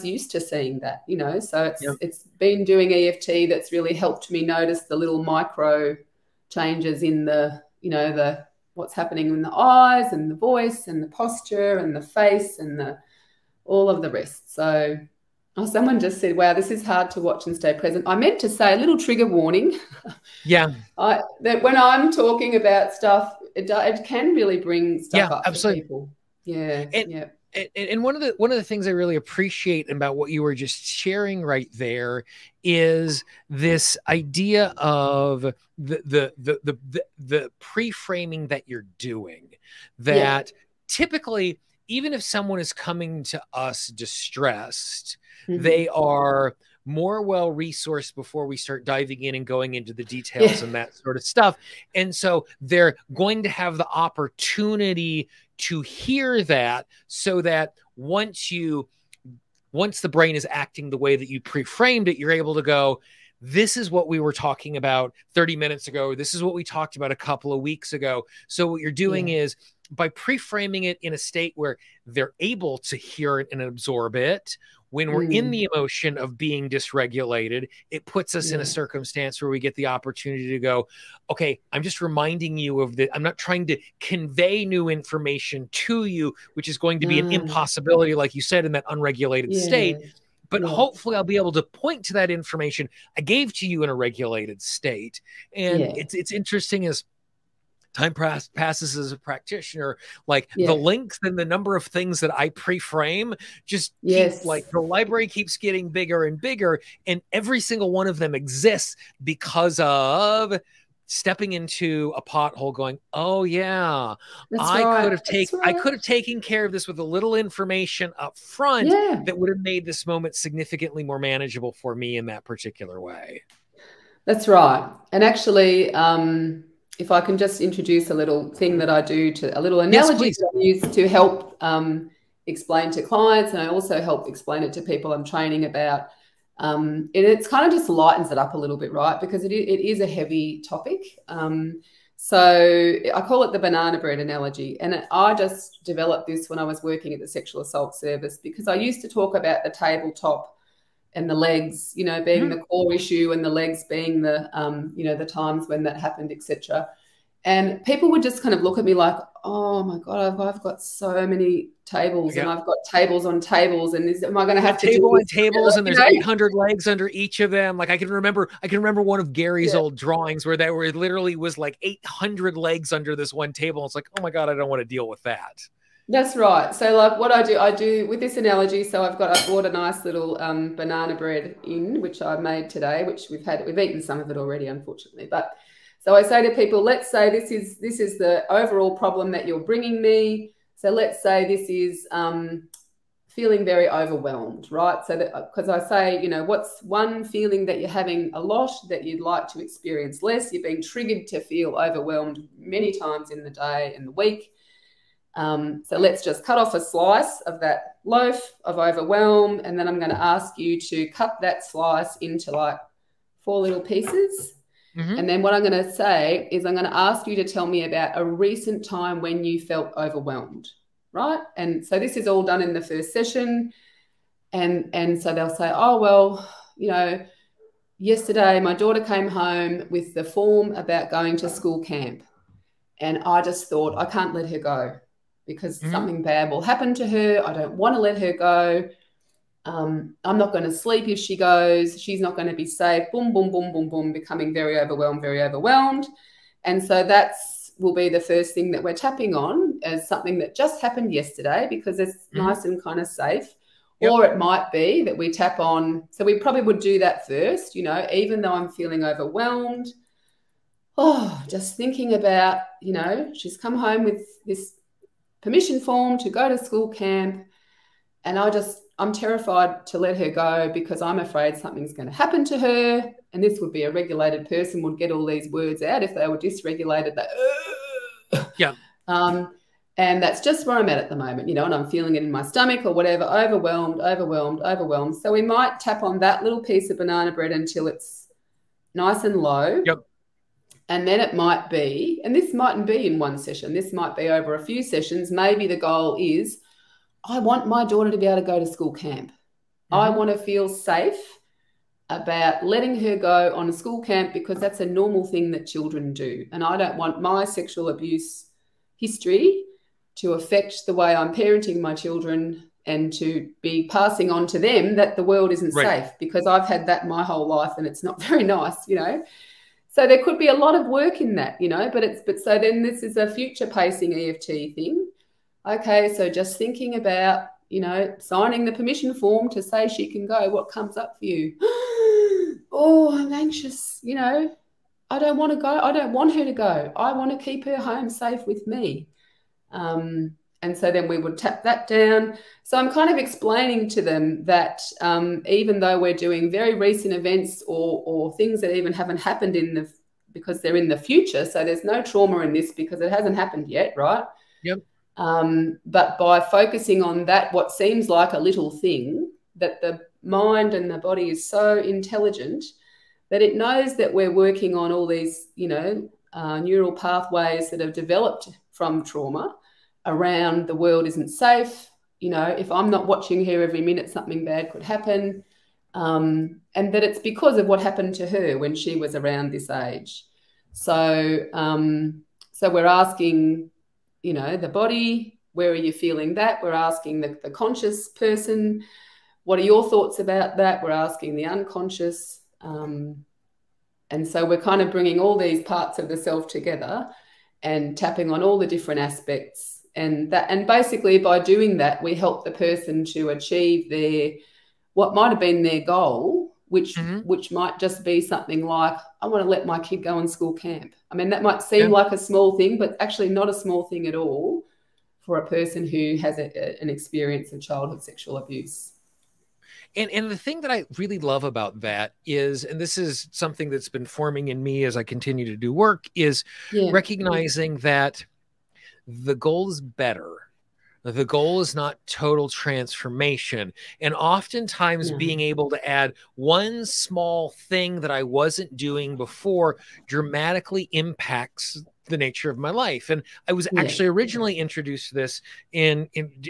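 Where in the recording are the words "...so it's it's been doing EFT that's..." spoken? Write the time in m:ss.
0:01.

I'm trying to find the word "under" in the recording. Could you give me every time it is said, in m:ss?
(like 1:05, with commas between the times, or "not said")
2:46, 2:52.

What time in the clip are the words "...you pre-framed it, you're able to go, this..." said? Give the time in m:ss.
1:01.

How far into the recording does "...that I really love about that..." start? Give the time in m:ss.
7:00.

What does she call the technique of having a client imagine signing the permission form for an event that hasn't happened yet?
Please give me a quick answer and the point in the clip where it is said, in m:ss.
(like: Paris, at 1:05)
Future pacing, at 5:23.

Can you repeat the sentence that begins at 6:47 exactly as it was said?
which might just be something like i want to let my kid go on school camp i mean that might seem yeah.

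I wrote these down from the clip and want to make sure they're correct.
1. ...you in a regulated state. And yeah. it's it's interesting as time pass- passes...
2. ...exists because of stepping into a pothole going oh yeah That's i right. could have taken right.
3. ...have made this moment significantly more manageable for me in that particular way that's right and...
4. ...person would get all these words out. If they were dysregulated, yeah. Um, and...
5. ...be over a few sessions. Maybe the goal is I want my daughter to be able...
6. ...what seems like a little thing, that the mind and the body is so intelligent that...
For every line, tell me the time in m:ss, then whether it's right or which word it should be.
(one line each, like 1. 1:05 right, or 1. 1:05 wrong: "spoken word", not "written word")
1. 1:33 right
2. 1:48 right
3. 1:59 right
4. 4:34 right
5. 4:54 right
6. 5:57 right.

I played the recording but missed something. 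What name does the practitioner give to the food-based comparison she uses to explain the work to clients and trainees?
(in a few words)
Banana bread analogy.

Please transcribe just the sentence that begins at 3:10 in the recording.
So let's say this is um, feeling very overwhelmed, right?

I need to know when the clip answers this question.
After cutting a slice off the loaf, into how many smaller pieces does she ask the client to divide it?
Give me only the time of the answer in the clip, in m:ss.
3:33.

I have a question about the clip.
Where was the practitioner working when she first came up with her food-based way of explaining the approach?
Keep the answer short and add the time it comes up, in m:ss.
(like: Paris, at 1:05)
Sexual assault service, at 2:27.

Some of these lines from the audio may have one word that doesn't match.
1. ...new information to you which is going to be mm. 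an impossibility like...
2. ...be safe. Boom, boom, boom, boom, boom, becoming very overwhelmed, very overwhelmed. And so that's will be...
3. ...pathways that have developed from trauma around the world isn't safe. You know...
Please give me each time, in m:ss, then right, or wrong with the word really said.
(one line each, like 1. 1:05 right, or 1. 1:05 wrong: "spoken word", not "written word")
1. 1:24 right
2. 4:02 right
3. 6:06 right.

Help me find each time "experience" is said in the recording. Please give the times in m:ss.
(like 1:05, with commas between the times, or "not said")
3:19, 6:56.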